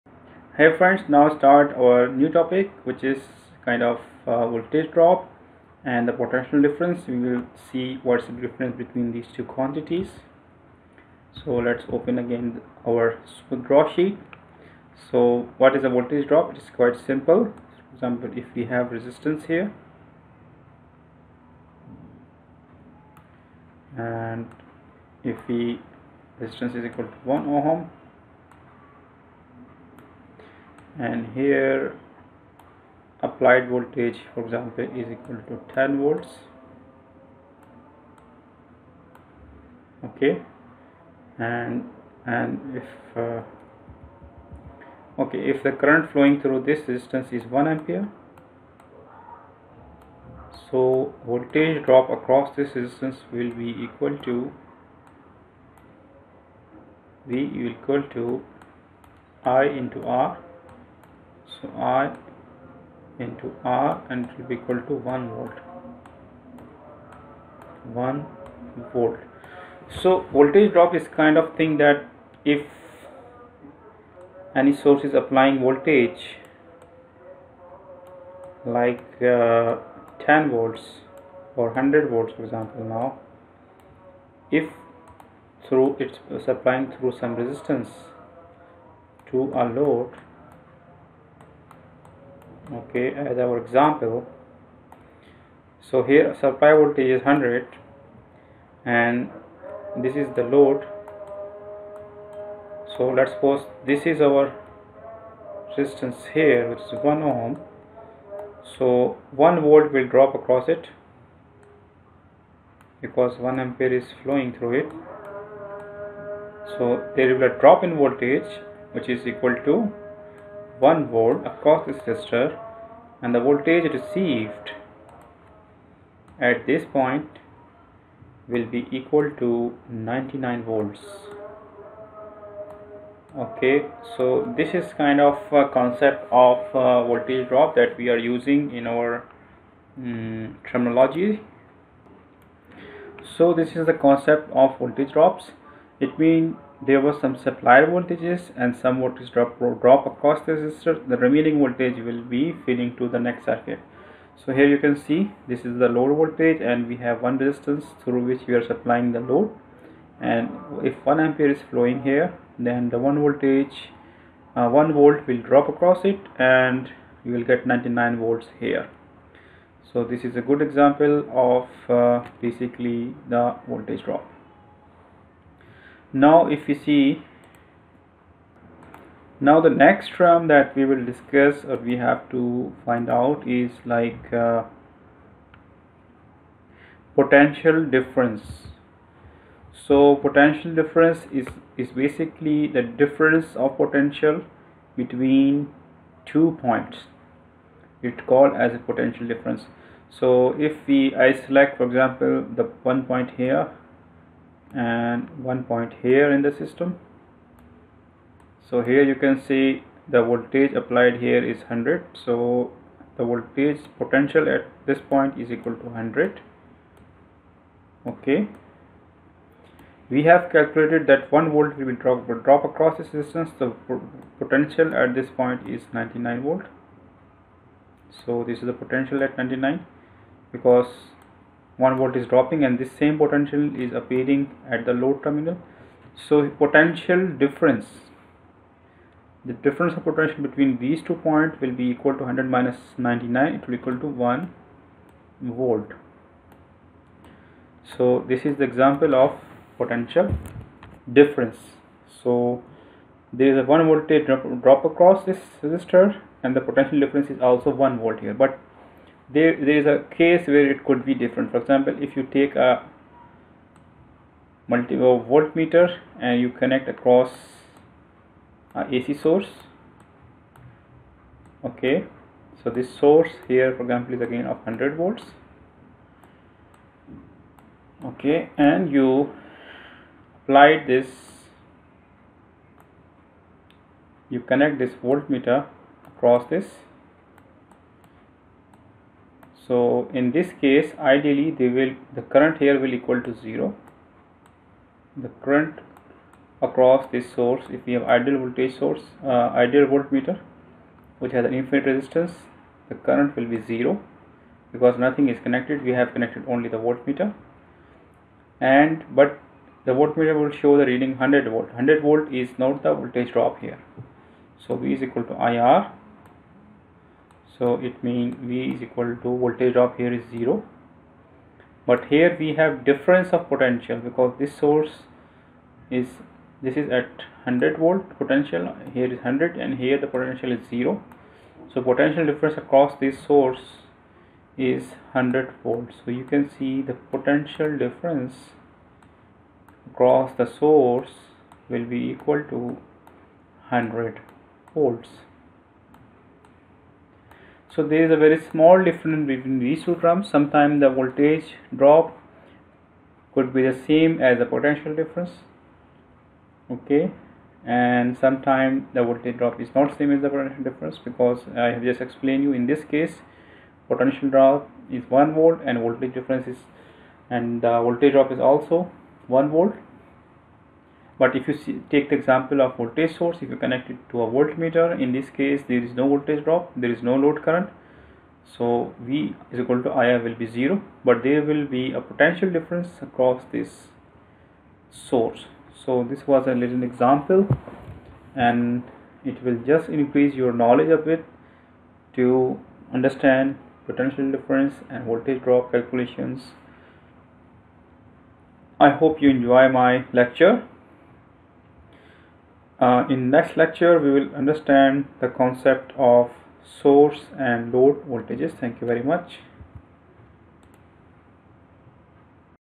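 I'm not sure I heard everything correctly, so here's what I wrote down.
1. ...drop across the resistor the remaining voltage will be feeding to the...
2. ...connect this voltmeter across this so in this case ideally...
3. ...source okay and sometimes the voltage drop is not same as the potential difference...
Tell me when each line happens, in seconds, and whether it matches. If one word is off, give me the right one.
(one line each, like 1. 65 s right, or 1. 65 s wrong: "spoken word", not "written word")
1. 149 s right
2. 284 s right
3. 354 s wrong: "difference", not "source".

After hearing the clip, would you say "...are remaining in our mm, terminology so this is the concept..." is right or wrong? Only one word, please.
wrong.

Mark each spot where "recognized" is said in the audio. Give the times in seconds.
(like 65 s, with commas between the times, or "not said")
not said.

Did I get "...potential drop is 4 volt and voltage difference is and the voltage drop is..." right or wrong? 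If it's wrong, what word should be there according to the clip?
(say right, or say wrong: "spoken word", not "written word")
wrong: "1", not "4".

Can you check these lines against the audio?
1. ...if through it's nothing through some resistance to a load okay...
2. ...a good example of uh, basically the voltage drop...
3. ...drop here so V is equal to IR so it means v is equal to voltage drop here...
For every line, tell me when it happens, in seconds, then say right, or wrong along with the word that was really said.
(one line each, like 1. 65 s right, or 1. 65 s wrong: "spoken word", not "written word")
1. 84 s wrong: "supplying", not "nothing"
2. 170 s right
3. 313 s right.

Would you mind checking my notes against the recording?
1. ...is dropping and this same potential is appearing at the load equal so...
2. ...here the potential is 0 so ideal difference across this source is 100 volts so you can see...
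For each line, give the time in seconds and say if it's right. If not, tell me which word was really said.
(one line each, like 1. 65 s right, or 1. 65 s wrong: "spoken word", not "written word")
1. 232 s wrong: "terminal", not "equal"
2. 329 s wrong: "potential", not "ideal".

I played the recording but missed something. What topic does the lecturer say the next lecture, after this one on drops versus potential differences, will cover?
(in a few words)
source and load voltages.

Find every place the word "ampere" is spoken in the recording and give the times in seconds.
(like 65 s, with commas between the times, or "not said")
47 s, 113 s, 161 s.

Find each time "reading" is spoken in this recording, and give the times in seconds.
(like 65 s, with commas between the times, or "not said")
310 s.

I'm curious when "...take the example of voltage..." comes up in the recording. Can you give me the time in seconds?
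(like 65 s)
371 s.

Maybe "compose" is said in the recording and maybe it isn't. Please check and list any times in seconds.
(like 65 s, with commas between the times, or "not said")
not said.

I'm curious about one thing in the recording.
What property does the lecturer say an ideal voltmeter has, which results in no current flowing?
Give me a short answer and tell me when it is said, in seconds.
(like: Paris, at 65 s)
infinite resistance, at 301 s.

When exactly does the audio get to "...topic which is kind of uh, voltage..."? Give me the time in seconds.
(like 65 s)
2 s.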